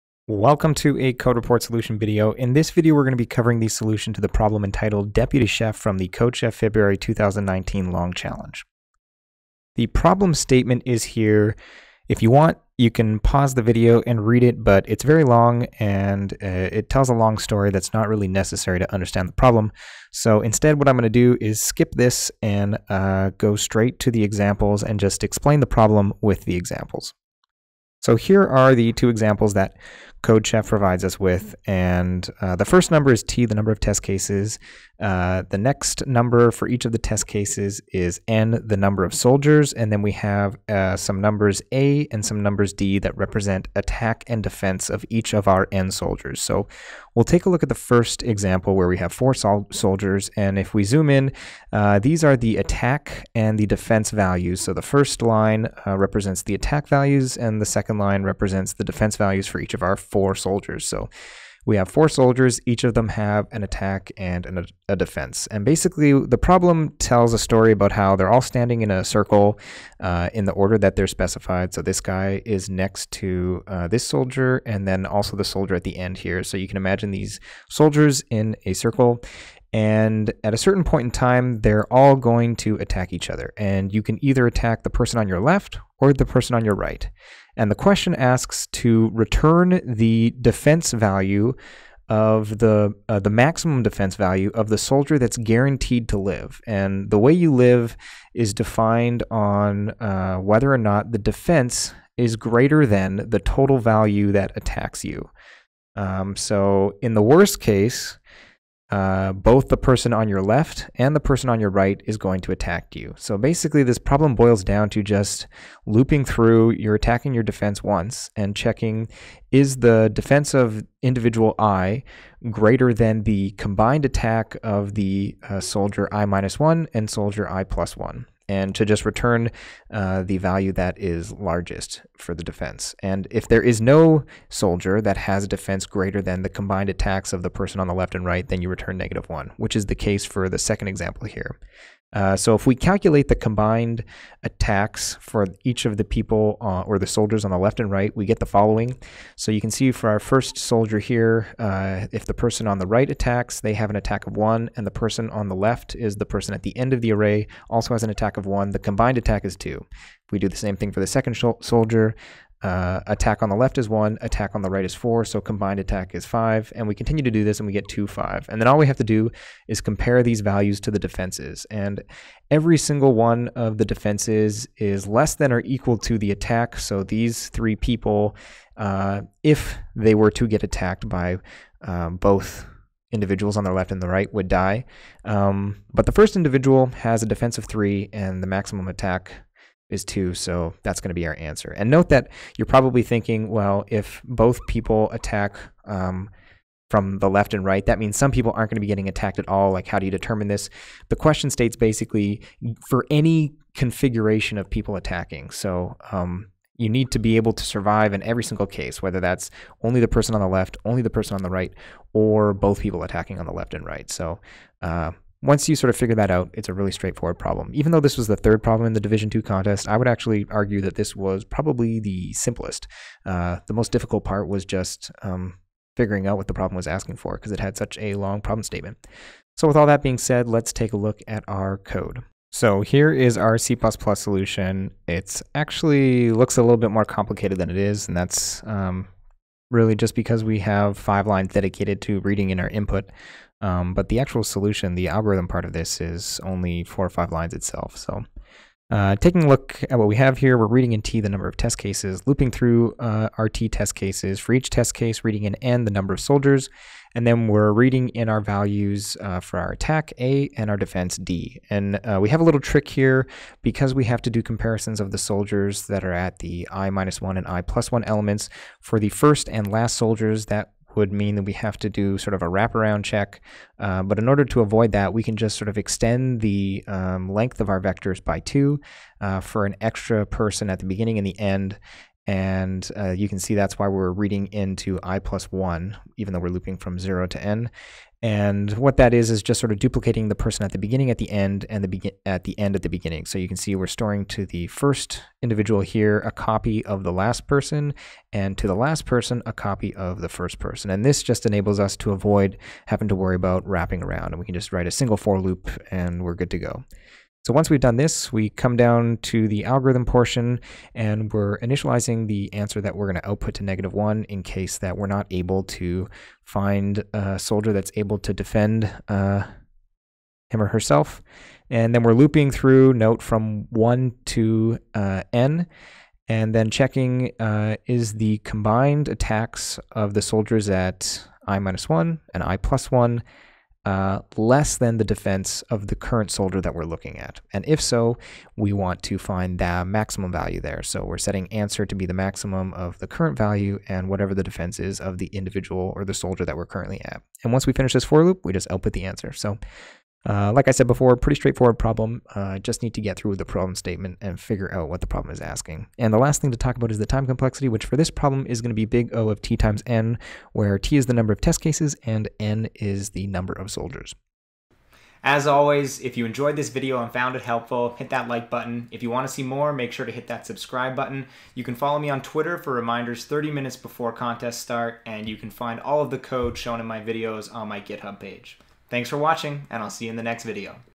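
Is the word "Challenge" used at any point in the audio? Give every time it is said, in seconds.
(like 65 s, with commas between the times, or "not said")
8 s.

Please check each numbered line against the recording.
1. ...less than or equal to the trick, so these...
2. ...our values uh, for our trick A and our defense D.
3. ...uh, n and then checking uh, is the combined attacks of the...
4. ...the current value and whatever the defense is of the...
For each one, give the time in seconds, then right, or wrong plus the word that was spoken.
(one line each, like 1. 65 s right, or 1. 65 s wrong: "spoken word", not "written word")
1. 175 s wrong: "attack", not "trick"
2. 258 s wrong: "attack", not "trick"
3. 324 s right
4. 342 s right.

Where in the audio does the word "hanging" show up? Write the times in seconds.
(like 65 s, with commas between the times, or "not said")
not said.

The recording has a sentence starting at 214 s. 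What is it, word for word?
So uh, once you sort of figure that out, it's a really straightforward problem.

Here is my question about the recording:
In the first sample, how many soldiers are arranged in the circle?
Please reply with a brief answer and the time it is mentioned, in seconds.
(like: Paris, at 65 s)
4, at 49 s.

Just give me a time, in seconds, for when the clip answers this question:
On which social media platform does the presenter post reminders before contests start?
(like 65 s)
372 s.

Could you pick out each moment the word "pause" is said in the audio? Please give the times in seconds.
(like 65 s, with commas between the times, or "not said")
13 s.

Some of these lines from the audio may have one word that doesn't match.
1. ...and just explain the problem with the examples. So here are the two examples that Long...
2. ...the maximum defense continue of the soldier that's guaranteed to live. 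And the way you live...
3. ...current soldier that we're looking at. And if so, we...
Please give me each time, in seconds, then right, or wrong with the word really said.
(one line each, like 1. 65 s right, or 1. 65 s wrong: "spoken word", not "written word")
1. 24 s wrong: "CodeChef", not "Long"
2. 93 s wrong: "value", not "continue"
3. 335 s right.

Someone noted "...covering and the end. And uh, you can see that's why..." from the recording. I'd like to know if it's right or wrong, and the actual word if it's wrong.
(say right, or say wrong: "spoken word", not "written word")
wrong: "beginning", not "covering".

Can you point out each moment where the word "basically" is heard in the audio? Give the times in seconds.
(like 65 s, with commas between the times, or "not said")
65 s, 113 s, 201 s.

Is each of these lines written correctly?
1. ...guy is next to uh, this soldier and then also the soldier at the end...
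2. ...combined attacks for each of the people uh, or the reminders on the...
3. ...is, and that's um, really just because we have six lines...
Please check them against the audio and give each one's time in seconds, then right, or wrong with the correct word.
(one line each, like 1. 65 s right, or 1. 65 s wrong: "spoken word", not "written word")
1. 72 s right
2. 143 s wrong: "soldiers", not "reminders"
3. 237 s wrong: "five", not "six".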